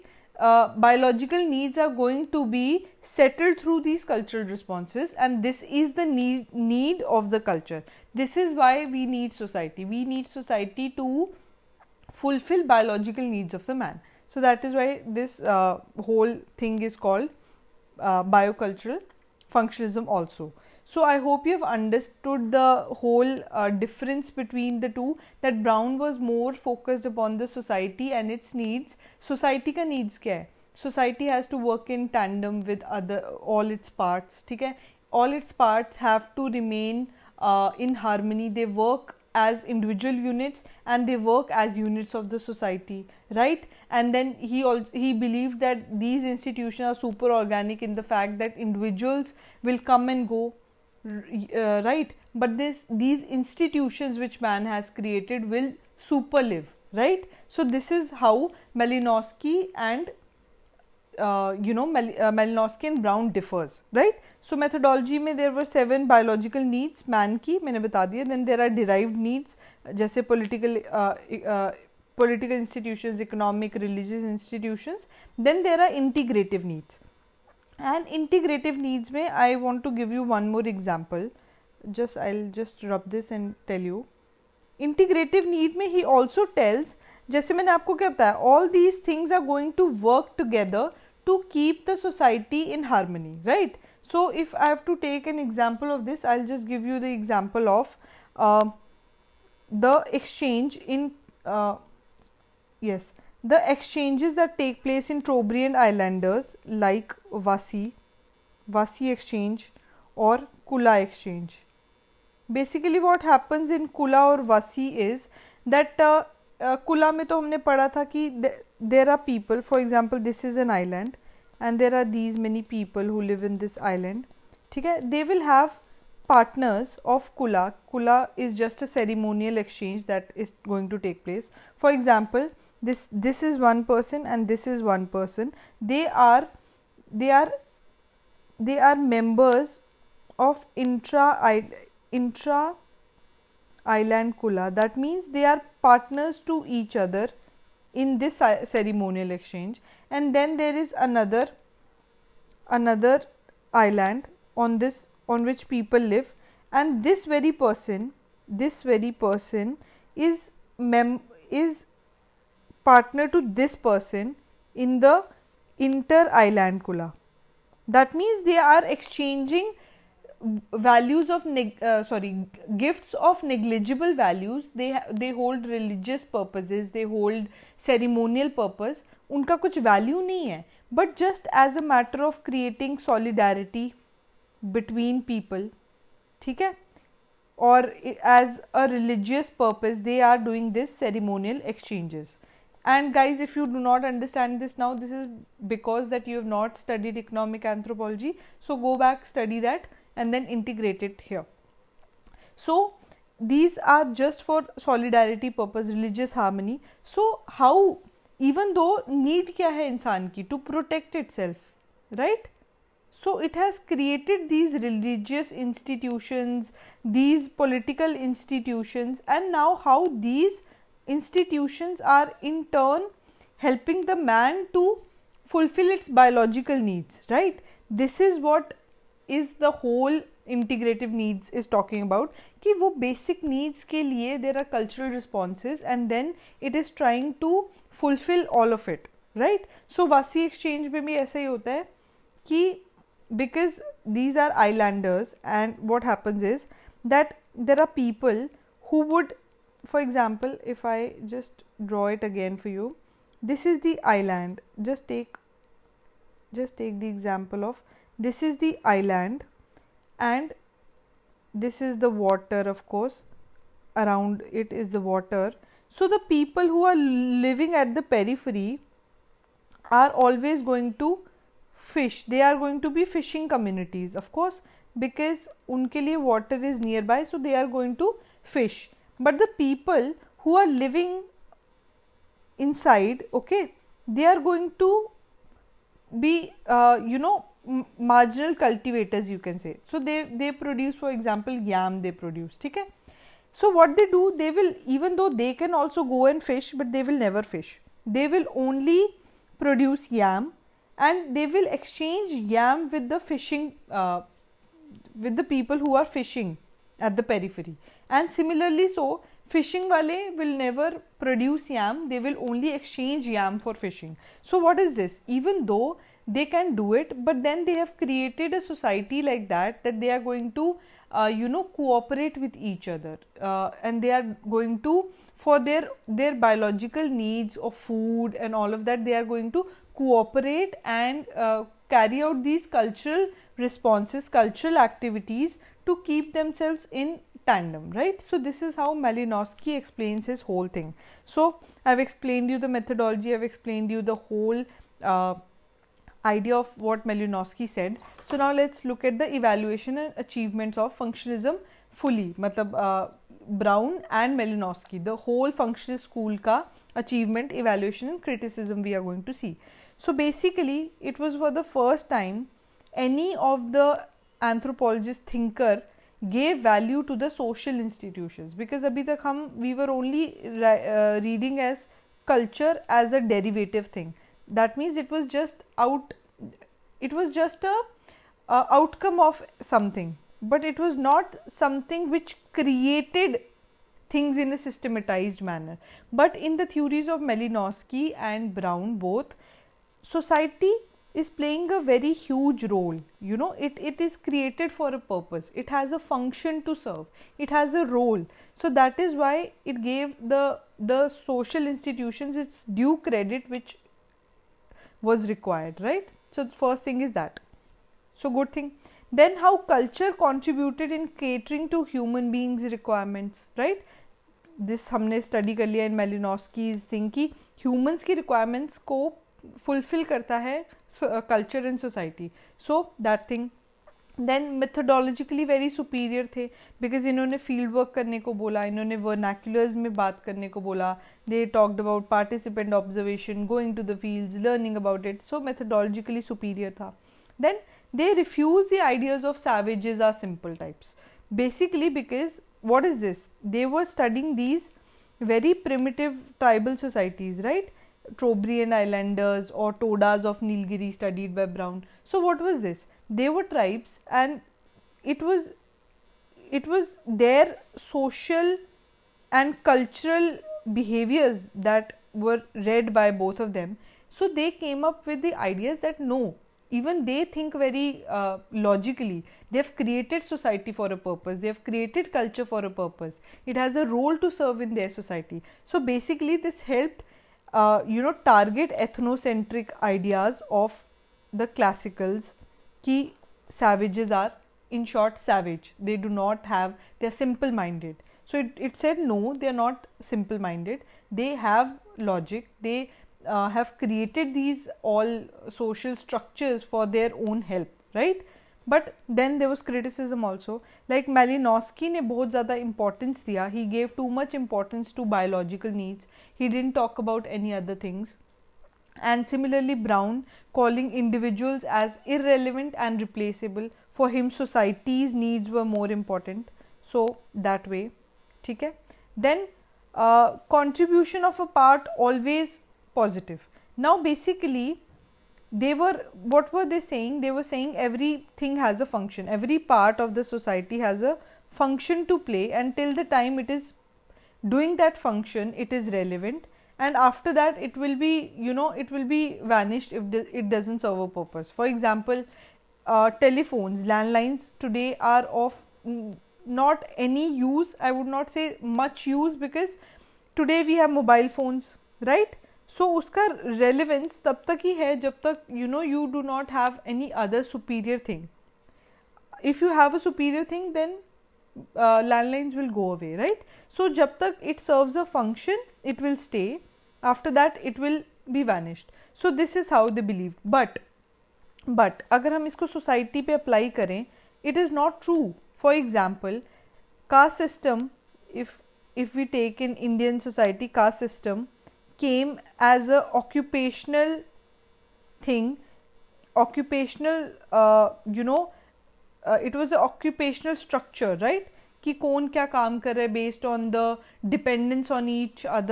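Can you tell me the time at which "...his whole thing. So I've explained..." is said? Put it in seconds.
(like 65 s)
340 s.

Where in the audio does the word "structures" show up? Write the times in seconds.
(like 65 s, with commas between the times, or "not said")
495 s, 590 s.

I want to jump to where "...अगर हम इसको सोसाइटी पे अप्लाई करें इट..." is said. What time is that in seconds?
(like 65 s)
572 s.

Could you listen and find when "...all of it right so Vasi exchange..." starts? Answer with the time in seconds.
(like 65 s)
238 s.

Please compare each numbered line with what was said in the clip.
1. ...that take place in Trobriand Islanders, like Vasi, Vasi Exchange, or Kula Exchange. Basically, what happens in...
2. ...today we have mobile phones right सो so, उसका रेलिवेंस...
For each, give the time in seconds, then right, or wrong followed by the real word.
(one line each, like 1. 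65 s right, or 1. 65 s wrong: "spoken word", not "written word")
1. 104 s right
2. 550 s right.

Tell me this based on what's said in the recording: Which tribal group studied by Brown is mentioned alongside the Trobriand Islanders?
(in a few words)
Todas of Nilgiri.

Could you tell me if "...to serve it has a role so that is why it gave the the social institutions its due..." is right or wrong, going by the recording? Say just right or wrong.
right.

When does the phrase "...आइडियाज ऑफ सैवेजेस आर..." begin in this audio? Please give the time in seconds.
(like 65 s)
438 s.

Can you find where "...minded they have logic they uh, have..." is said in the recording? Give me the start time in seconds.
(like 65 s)
490 s.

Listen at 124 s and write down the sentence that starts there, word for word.
ठीक है they will have partners of Kula.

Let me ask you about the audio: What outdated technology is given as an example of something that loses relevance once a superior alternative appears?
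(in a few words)
Landlines.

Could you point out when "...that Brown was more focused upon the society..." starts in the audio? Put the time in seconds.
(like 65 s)
25 s.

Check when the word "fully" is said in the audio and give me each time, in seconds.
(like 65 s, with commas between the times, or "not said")
351 s.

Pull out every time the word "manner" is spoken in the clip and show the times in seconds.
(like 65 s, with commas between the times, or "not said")
385 s.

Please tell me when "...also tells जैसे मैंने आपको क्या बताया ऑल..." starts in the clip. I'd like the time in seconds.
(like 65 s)
86 s.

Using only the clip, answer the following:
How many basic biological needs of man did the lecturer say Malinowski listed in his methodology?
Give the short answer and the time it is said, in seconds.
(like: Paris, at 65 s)
7, at 65 s.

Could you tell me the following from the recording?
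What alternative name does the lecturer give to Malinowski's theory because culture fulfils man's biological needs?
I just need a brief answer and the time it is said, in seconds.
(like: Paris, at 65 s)
Biocultural functionalism, at 18 s.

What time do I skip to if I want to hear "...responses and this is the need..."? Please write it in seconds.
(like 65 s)
4 s.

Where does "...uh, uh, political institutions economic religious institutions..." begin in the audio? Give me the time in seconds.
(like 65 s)
70 s.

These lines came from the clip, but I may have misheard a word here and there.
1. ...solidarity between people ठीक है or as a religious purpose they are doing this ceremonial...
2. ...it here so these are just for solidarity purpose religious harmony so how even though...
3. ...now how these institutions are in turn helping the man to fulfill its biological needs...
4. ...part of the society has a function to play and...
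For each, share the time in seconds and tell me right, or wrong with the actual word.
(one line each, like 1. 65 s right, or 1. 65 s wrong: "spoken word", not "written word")
1. 183 s right
2. 201 s right
3. 219 s right
4. 529 s right.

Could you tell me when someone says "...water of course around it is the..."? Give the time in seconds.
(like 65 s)
262 s.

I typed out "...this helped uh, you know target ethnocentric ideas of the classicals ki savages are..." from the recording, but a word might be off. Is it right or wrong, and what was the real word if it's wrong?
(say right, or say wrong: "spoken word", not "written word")
right.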